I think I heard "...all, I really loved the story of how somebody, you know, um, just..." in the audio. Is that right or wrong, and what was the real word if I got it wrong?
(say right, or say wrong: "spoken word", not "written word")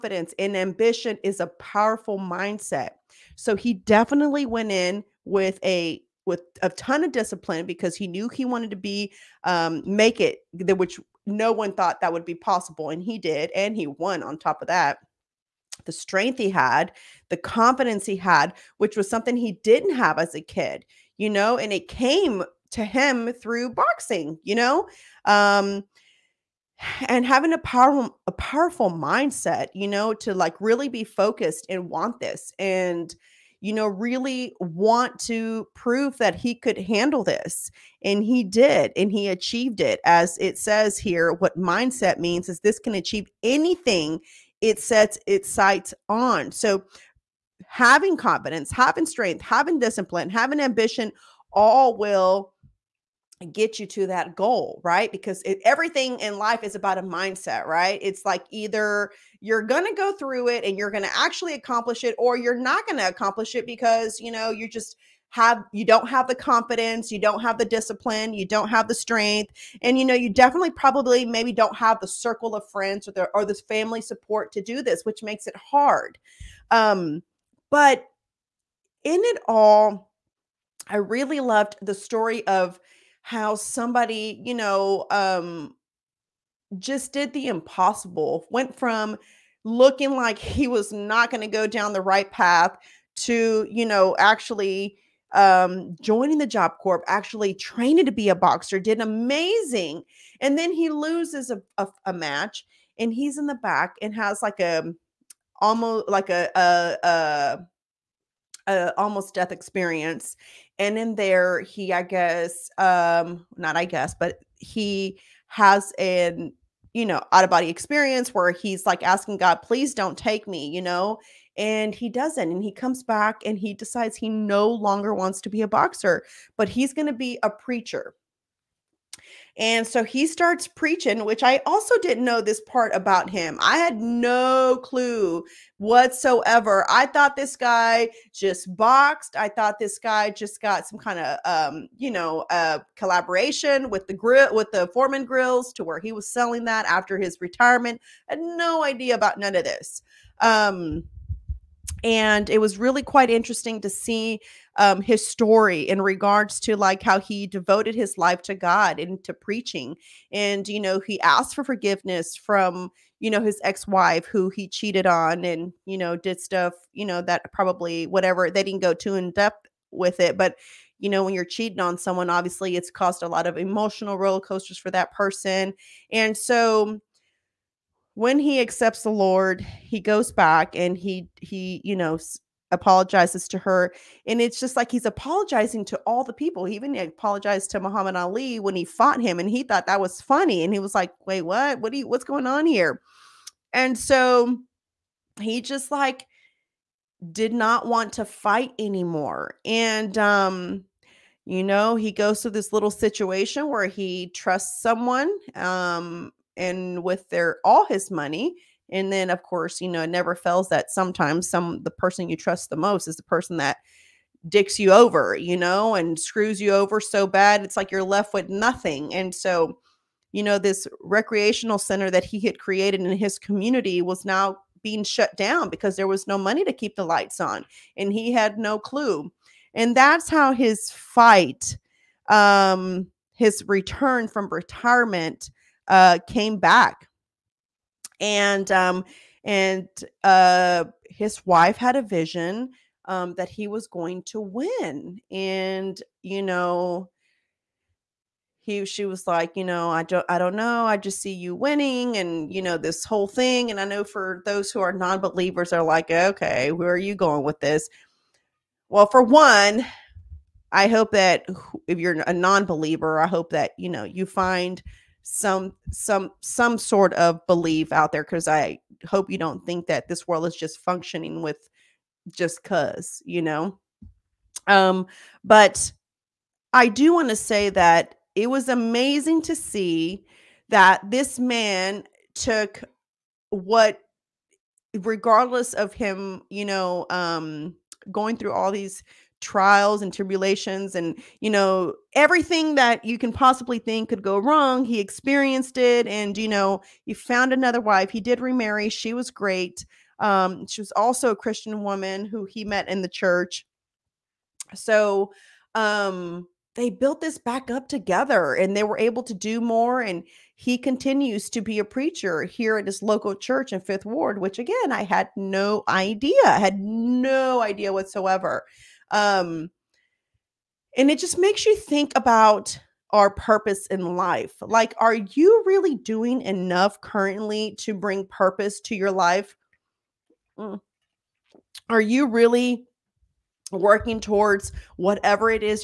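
right.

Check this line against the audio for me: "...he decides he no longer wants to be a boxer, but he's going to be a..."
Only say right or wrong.
right.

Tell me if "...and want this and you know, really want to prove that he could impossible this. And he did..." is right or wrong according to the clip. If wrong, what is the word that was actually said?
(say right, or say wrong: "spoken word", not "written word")
wrong: "handle", not "impossible".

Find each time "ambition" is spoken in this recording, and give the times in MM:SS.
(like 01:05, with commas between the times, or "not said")
00:00, 00:50.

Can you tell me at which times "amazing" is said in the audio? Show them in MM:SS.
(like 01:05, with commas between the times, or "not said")
01:38, 04:38.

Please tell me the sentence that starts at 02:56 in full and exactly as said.
And so, when he accepts the lord he goes back and he he you know apologizes to her.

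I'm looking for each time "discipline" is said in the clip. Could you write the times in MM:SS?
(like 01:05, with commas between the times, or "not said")
00:07, 00:49, 01:07.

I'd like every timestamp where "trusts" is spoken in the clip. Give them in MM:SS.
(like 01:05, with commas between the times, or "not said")
03:24, 03:32.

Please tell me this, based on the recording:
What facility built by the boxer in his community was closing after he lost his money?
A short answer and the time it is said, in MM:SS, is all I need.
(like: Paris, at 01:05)
recreational center, at 03:41.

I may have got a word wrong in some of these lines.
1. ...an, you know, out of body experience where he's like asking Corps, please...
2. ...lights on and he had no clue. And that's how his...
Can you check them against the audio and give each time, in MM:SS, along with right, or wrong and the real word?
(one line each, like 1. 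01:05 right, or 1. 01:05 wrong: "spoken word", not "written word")
1. 01:55 wrong: "God", not "Corps"
2. 03:47 right.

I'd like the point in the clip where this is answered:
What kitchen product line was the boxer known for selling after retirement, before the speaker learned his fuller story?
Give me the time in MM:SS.
02:24.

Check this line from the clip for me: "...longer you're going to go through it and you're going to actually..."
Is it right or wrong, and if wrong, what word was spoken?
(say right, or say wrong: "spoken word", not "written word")
wrong: "either", not "longer".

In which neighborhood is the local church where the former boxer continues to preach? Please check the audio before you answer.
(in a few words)
Fifth Ward.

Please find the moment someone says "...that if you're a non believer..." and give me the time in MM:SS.
04:21.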